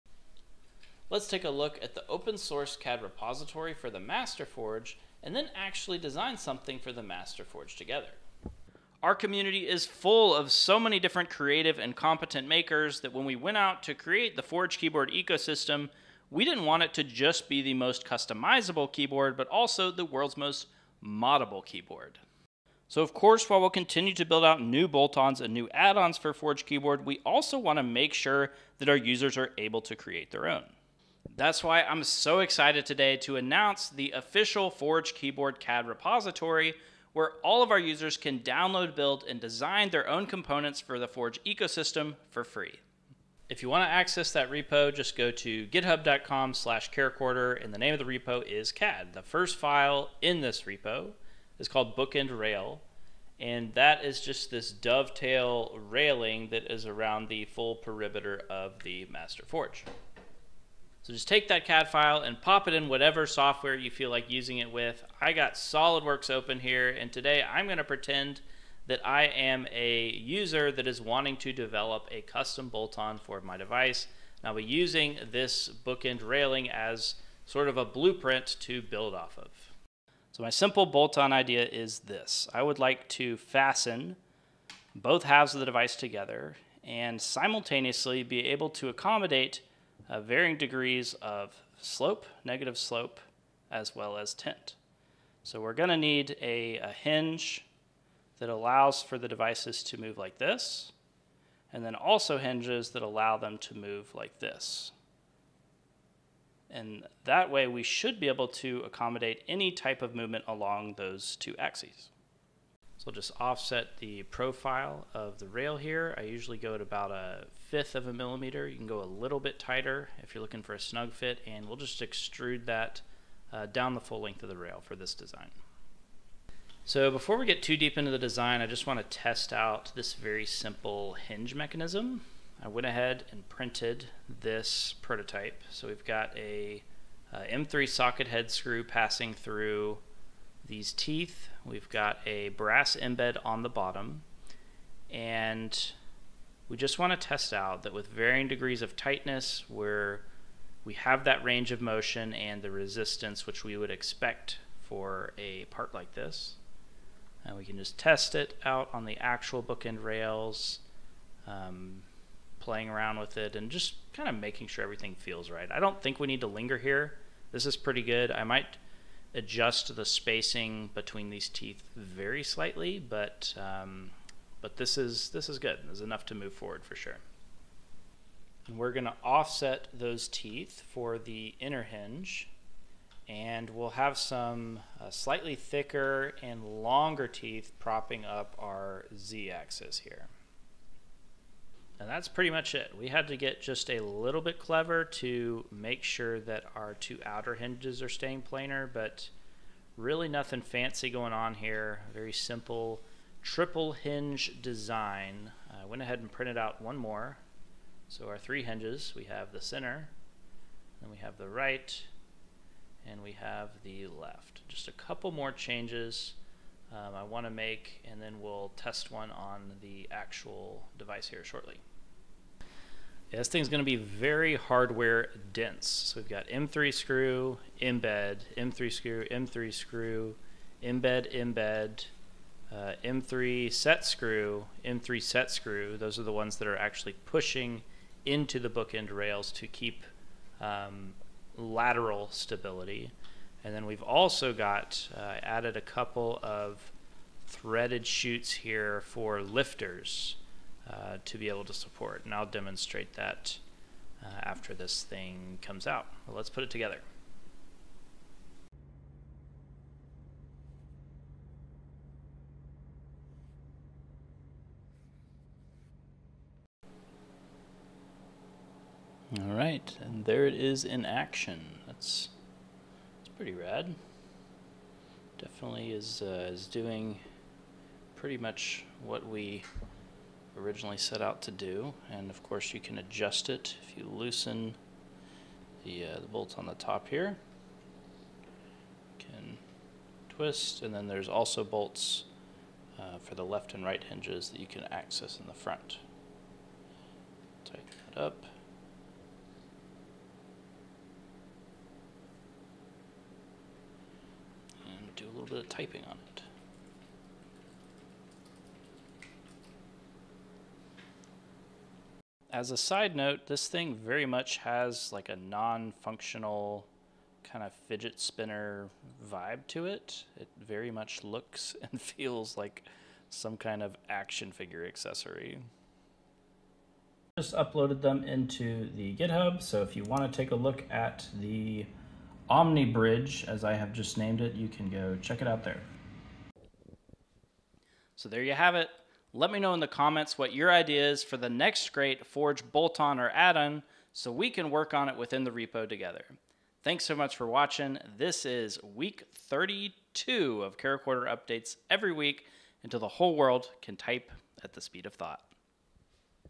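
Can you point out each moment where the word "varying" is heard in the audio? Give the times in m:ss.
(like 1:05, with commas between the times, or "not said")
1:30, 2:28.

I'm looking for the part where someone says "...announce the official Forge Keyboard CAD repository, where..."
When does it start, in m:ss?
0:33.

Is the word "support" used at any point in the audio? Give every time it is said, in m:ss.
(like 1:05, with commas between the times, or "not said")
4:11.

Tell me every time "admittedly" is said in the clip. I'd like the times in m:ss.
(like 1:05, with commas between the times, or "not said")
not said.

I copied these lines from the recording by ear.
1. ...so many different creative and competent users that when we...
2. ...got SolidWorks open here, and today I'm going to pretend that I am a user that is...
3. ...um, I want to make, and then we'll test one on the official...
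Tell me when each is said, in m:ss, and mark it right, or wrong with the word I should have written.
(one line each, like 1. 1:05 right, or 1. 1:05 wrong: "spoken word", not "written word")
1. 0:10 wrong: "makers", not "users"
2. 1:05 right
3. 3:36 wrong: "actual", not "official".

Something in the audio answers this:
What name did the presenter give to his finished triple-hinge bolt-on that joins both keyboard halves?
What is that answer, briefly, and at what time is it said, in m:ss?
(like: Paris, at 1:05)
Omnibridge, at 5:32.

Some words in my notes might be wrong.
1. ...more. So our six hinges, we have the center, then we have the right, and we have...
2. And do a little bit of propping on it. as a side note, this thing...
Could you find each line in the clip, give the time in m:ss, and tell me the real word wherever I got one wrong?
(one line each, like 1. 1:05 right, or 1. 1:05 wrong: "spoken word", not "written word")
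1. 3:26 wrong: "three", not "six"
2. 5:04 wrong: "typing", not "propping".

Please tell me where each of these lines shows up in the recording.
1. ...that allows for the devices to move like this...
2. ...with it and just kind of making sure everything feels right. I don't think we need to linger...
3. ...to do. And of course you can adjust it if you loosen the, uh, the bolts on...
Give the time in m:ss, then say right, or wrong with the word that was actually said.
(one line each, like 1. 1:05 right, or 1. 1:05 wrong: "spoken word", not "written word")
1. 1:38 right
2. 2:43 right
3. 4:41 right.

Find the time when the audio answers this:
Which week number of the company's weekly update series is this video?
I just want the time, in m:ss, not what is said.
5:48.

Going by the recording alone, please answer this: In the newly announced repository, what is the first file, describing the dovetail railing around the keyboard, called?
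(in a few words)
Bookend Rail.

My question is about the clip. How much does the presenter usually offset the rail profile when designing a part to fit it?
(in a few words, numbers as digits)
a fifth of a millimeter.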